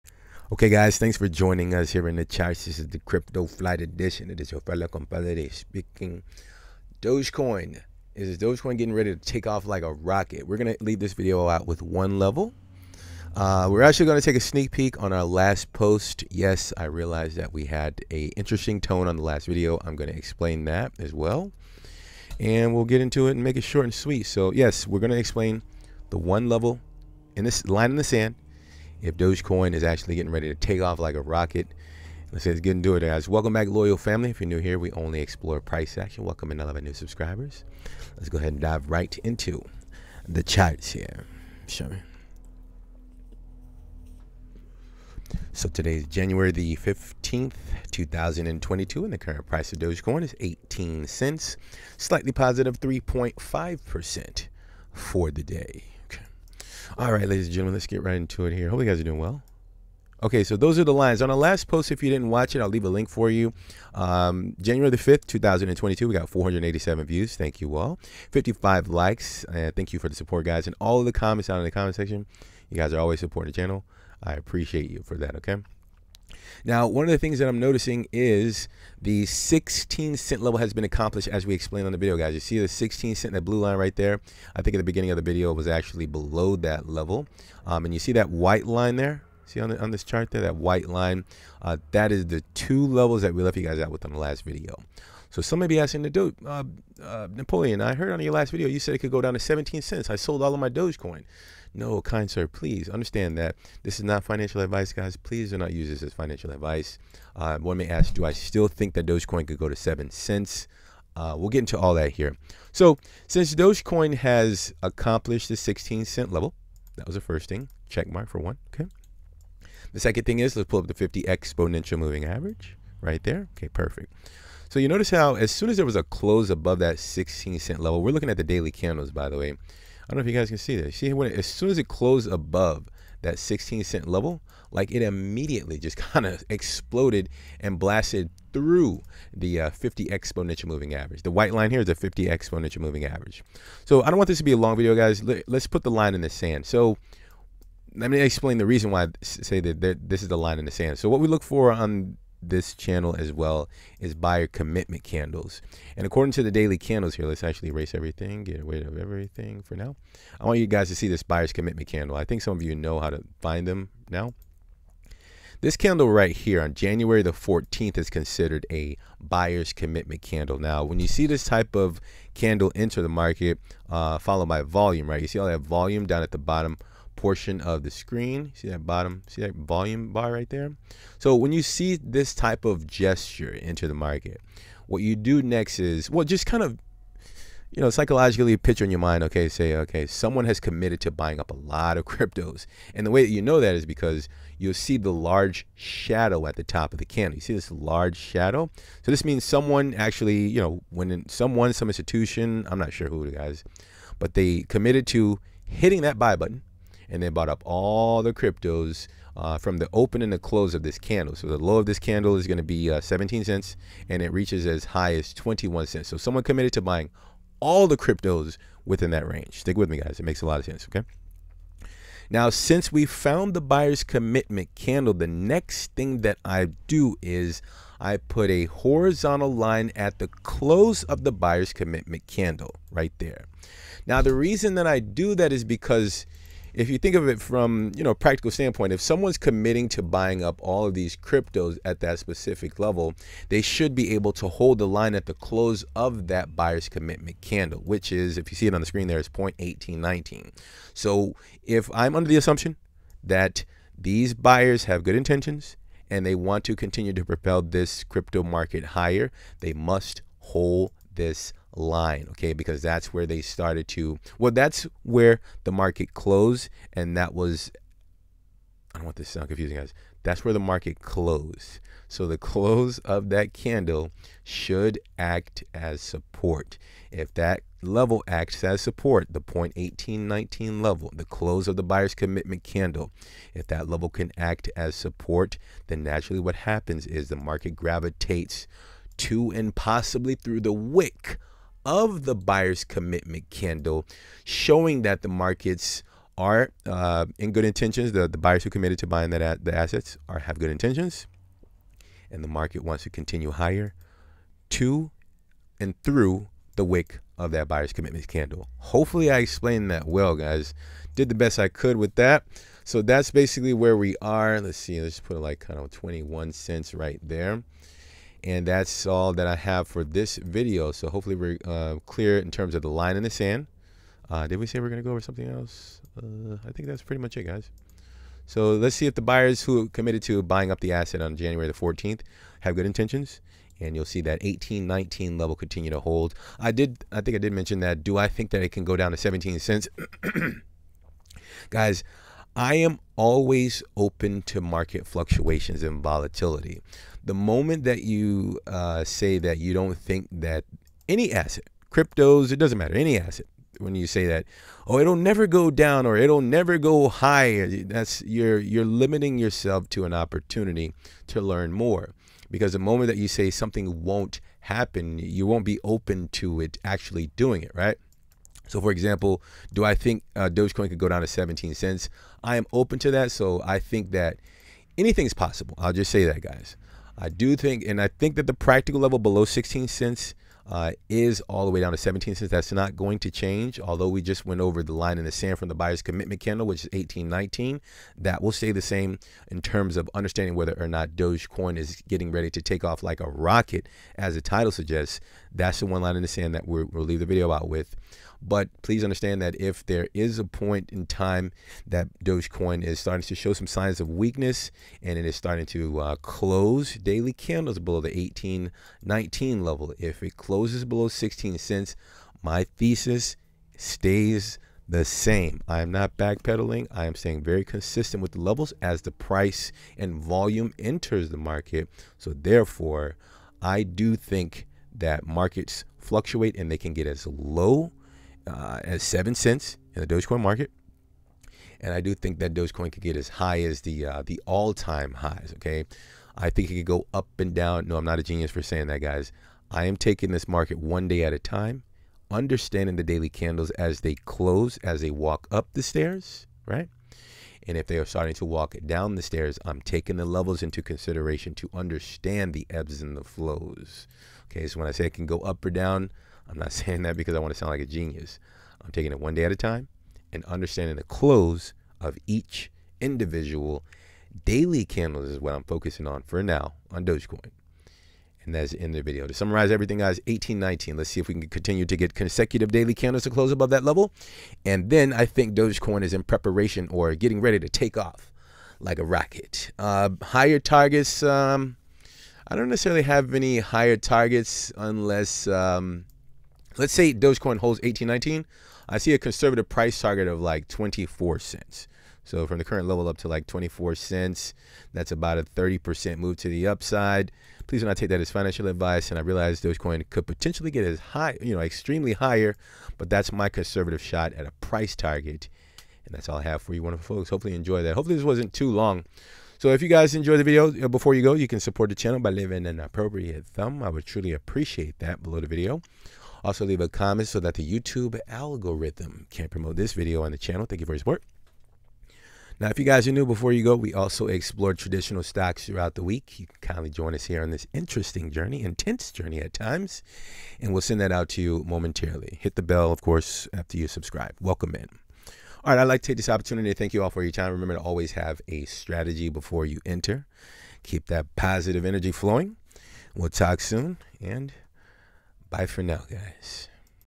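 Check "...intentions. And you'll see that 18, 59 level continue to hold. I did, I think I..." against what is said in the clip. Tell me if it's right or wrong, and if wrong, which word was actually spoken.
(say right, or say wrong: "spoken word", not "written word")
wrong: "19", not "59".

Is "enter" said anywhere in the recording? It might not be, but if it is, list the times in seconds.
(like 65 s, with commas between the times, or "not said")
172 s, 183 s, 420 s, 539 s.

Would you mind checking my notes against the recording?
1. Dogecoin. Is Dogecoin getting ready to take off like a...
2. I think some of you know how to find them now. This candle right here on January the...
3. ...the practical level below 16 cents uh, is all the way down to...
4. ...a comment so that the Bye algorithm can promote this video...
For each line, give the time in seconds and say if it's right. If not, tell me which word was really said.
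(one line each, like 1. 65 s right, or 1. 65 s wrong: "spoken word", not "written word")
1. 7 s right
2. 162 s right
3. 378 s right
4. 516 s wrong: "YouTube", not "Bye".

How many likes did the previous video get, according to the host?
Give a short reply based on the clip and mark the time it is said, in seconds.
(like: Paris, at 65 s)
55, at 68 s.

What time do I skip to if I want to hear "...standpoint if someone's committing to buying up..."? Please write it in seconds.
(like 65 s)
238 s.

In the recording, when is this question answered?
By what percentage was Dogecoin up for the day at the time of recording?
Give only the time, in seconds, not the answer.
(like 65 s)
52 s.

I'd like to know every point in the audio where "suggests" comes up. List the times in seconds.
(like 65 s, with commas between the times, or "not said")
394 s.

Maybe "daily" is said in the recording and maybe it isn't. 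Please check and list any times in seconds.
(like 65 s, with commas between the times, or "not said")
128 s, 156 s, 406 s, 443 s, 464 s, 472 s.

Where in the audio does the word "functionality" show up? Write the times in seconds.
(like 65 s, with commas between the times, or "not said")
not said.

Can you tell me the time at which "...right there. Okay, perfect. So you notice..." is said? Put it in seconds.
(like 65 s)
123 s.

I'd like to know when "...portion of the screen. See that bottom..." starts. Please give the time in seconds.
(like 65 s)
177 s.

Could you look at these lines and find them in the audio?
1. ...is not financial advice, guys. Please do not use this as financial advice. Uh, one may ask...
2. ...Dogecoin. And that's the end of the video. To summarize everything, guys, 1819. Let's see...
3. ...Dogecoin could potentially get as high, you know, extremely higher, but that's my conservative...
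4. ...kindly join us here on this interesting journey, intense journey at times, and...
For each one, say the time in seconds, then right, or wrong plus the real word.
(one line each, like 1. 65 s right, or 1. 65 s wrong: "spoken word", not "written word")
1. 103 s right
2. 467 s right
3. 499 s right
4. 526 s right.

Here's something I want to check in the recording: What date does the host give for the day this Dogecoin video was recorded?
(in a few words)
January 15, 2022.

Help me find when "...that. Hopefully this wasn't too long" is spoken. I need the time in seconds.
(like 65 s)
507 s.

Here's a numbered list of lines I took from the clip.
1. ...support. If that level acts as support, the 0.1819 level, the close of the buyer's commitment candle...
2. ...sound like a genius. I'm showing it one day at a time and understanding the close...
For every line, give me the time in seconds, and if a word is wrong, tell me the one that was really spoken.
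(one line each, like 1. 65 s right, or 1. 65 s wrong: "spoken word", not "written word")
1. 276 s right
2. 457 s wrong: "taking", not "showing".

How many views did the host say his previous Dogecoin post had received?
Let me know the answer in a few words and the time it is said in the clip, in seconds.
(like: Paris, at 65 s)
487, at 66 s.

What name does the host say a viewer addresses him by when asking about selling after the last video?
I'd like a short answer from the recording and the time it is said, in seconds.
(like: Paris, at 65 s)
Napoleon, at 97 s.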